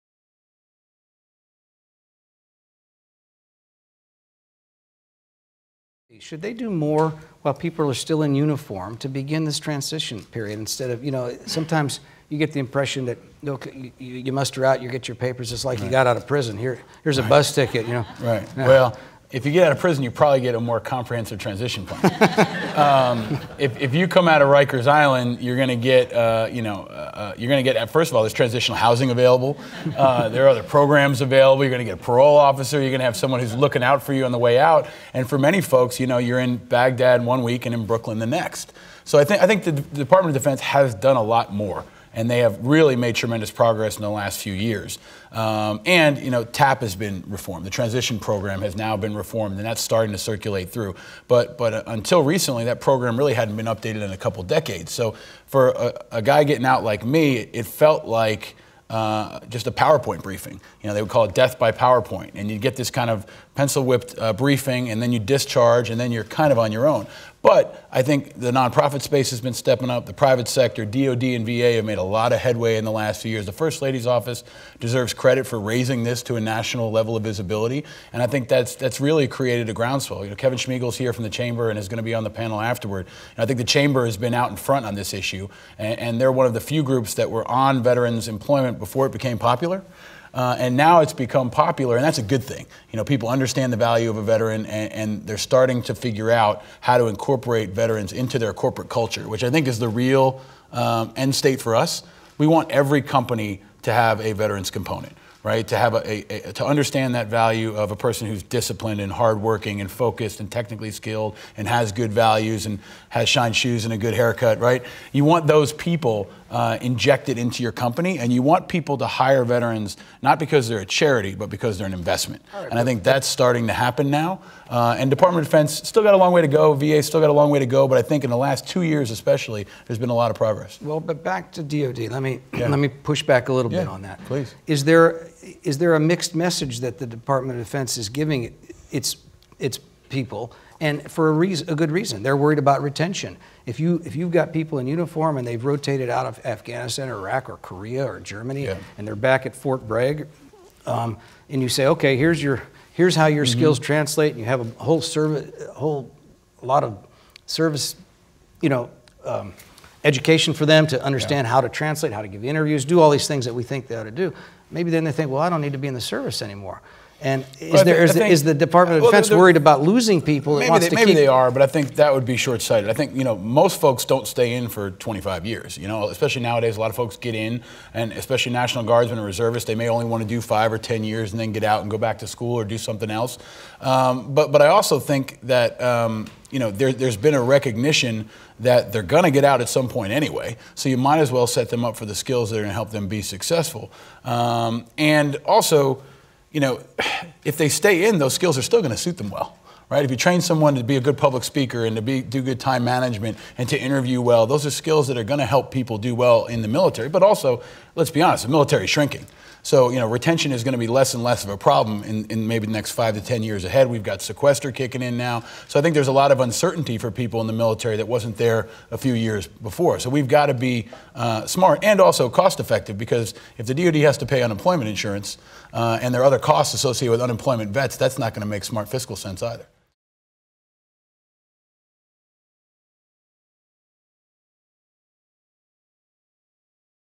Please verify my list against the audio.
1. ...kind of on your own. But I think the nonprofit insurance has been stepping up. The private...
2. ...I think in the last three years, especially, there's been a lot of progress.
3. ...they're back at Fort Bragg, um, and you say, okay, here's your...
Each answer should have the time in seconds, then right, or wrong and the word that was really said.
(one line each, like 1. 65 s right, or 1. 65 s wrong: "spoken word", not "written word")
1. 66 s wrong: "space", not "insurance"
2. 127 s wrong: "two", not "three"
3. 149 s right.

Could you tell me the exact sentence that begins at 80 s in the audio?
You know, Kevin Schmiegel's here from the chamber and is going to be on the panel afterward.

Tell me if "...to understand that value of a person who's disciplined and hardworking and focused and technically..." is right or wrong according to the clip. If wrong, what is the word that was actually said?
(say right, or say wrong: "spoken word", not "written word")
right.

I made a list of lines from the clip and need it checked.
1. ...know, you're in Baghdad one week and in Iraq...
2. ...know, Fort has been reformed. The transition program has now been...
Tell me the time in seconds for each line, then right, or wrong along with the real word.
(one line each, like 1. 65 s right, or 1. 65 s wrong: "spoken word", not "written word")
1. 36 s wrong: "Brooklyn", not "Iraq"
2. 46 s wrong: "TAP", not "Fort".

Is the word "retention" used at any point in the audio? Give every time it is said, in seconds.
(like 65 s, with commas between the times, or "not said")
142 s, 210 s.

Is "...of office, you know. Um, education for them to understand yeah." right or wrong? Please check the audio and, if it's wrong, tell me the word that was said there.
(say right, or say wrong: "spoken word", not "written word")
wrong: "service", not "office".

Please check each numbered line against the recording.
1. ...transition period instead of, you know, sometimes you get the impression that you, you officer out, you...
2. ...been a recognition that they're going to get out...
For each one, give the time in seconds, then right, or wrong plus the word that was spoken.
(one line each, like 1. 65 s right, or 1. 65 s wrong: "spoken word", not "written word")
1. 9 s wrong: "muster", not "officer"
2. 187 s right.